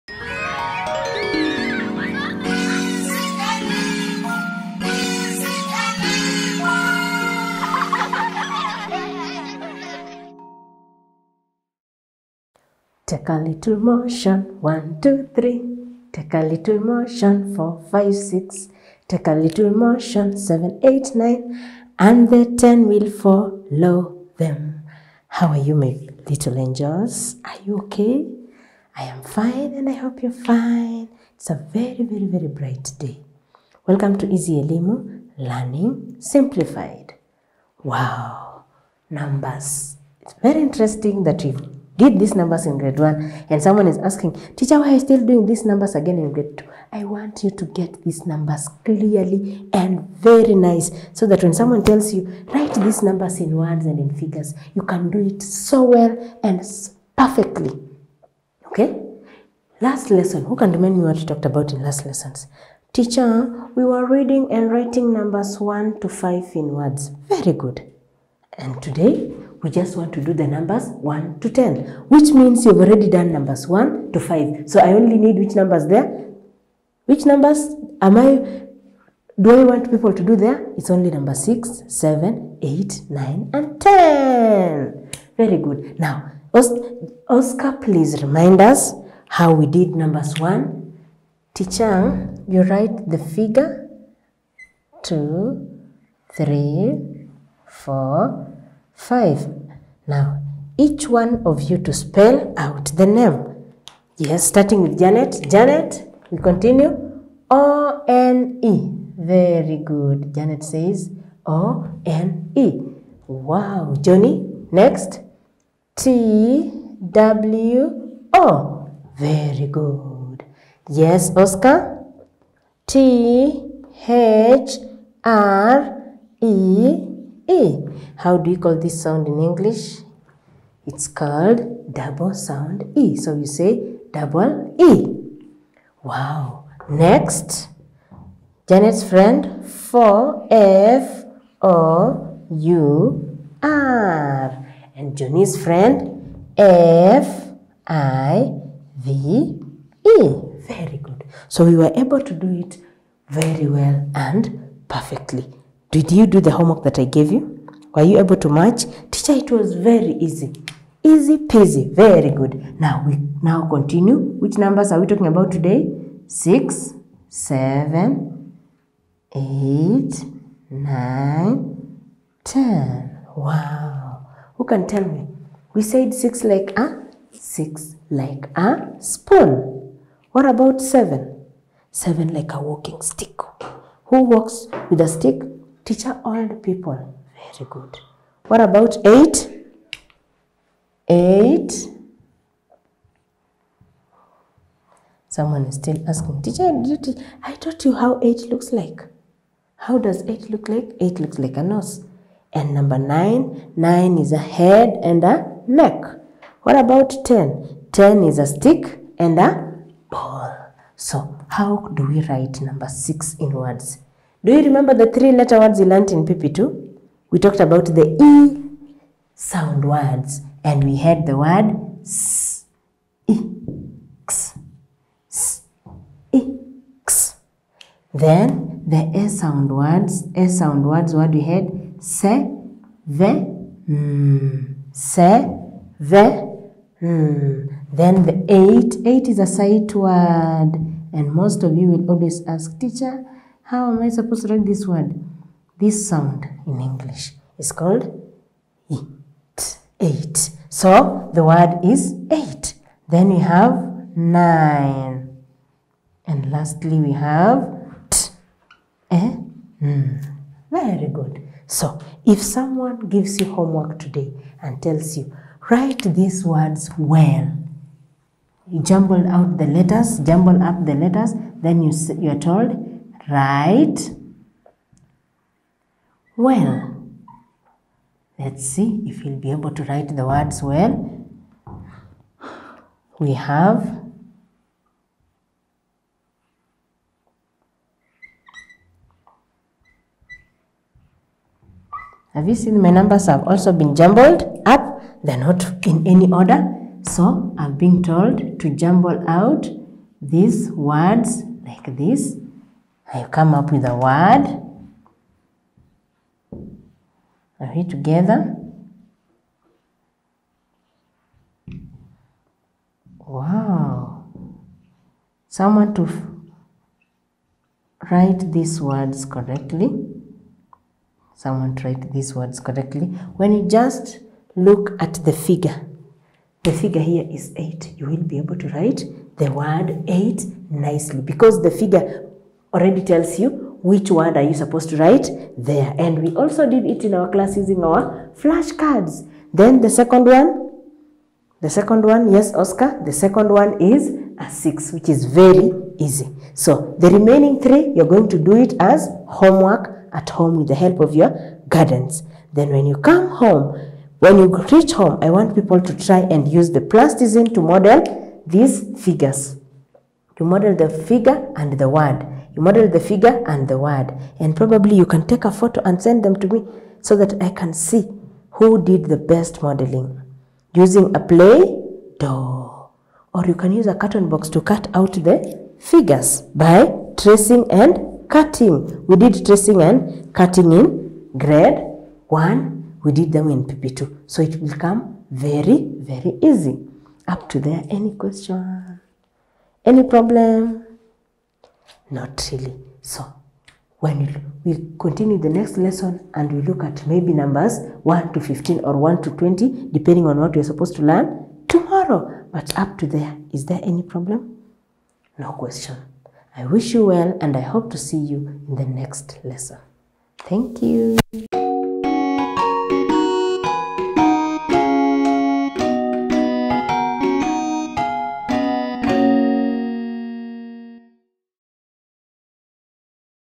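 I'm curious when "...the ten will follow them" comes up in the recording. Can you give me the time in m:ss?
0:22.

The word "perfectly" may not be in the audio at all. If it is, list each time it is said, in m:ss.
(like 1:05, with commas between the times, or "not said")
0:57, 2:34.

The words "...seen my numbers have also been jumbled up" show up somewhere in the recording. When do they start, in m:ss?
4:52.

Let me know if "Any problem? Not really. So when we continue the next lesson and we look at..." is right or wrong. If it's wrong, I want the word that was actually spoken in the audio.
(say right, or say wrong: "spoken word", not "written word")
right.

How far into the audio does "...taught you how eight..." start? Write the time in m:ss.
3:17.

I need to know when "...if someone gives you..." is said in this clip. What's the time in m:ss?
4:22.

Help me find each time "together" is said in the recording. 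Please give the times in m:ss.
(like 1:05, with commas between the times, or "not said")
5:07.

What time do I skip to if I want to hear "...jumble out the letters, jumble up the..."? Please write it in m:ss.
4:28.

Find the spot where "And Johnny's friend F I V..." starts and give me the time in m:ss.
2:24.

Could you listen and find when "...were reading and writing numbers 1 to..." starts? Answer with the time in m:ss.
1:03.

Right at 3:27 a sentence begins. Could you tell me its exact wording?
Ten is a stick and a ball.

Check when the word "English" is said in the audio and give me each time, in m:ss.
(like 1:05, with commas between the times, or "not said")
2:09, 4:06.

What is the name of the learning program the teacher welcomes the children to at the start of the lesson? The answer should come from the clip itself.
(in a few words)
Easy Elimu.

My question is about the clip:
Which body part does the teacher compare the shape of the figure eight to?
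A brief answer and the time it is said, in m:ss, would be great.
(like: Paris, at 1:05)
a nose, at 3:21.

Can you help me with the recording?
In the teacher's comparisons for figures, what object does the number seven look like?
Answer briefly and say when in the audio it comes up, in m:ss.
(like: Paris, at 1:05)
a walking stick, at 3:02.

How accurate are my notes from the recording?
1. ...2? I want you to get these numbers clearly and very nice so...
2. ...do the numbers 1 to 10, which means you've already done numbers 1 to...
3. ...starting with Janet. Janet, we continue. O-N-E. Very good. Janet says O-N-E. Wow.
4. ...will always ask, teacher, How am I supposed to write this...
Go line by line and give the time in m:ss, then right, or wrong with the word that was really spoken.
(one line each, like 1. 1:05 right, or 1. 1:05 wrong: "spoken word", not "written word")
1. 0:46 right
2. 1:10 right
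3. 1:44 right
4. 4:01 right.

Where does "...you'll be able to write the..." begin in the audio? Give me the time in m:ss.
4:39.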